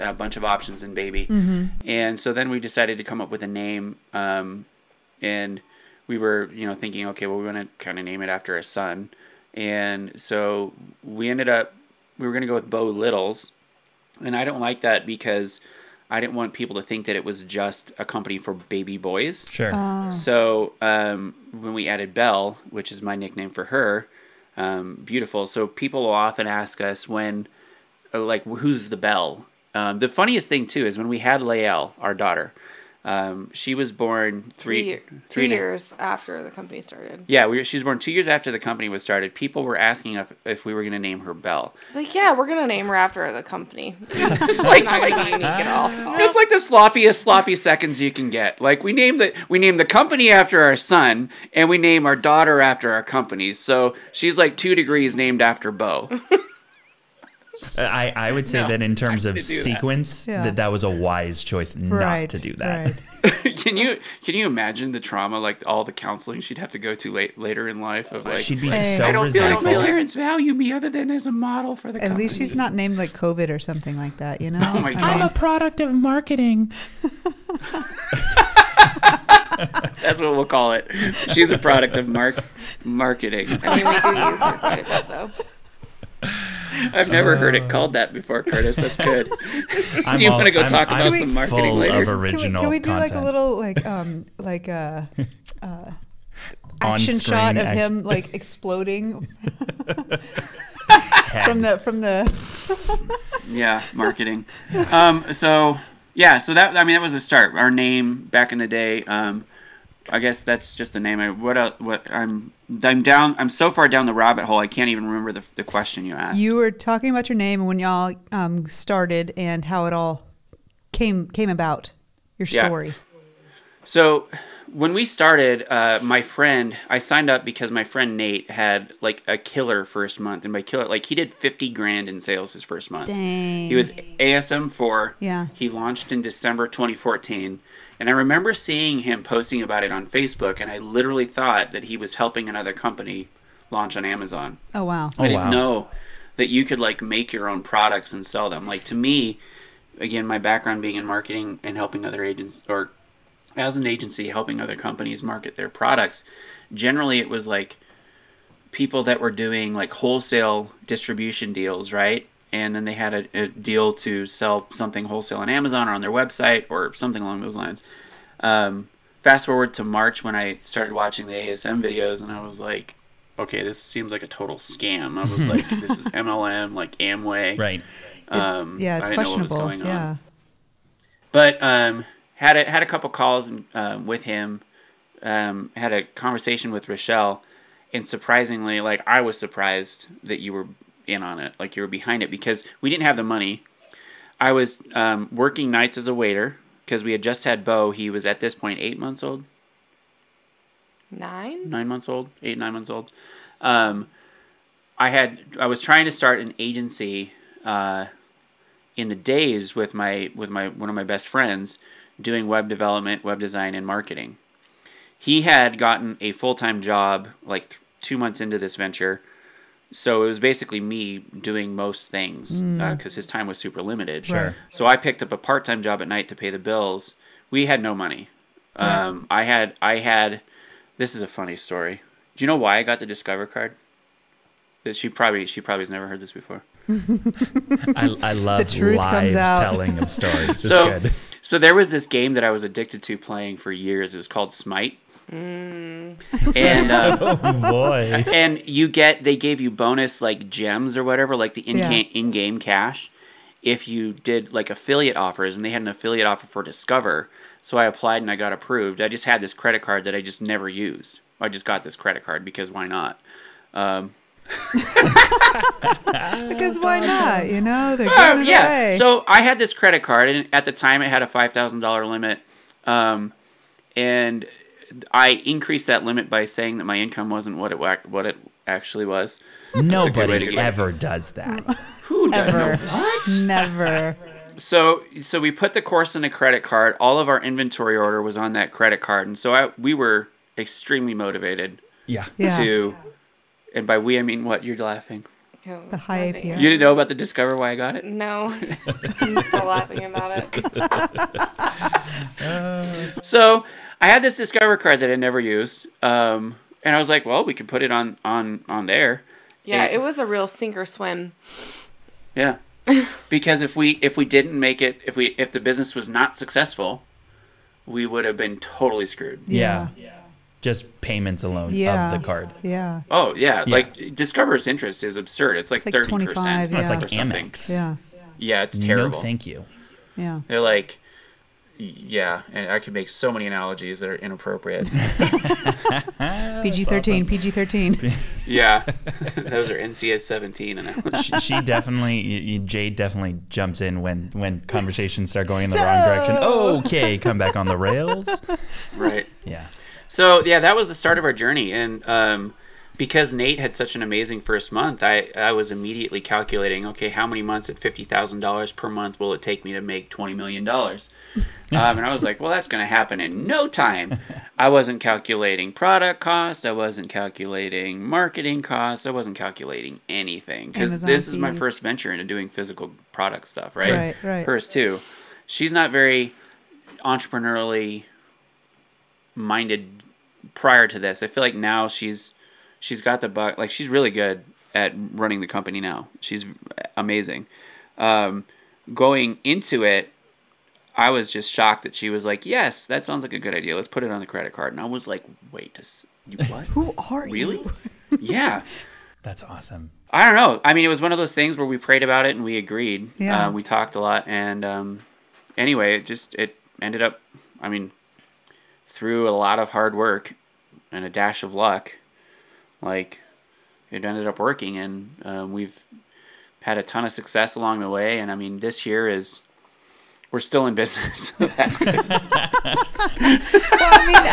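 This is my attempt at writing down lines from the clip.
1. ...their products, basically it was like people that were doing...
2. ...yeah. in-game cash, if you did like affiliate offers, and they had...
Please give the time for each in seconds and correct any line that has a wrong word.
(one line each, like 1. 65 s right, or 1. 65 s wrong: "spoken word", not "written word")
1. 155 s wrong: "generally", not "basically"
2. 251 s right.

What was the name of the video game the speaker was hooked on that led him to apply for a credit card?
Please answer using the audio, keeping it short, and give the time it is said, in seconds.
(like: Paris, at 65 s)
Smite, at 244 s.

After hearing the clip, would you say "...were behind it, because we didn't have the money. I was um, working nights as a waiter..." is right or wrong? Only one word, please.
right.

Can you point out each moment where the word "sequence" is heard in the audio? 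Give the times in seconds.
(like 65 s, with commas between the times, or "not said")
59 s.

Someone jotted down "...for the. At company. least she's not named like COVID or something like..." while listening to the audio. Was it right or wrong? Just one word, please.
right.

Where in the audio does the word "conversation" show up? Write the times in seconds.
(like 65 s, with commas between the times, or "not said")
186 s, 344 s.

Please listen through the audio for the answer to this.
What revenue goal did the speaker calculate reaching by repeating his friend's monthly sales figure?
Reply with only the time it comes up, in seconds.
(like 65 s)
360 s.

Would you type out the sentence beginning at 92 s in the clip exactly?
Of original can we, can we do content.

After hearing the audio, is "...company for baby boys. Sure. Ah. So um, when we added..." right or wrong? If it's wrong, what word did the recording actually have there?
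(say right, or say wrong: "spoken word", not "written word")
right.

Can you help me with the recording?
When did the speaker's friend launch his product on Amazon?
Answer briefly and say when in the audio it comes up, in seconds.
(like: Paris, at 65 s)
December 2014, at 136 s.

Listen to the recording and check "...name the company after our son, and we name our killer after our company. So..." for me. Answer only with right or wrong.
wrong.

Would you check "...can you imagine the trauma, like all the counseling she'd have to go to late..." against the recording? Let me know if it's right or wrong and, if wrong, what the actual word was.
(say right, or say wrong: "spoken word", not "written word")
right.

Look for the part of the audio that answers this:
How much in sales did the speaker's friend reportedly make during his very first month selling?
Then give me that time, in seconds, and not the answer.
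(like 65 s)
131 s.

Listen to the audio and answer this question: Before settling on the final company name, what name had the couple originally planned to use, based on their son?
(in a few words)
Beau Littles.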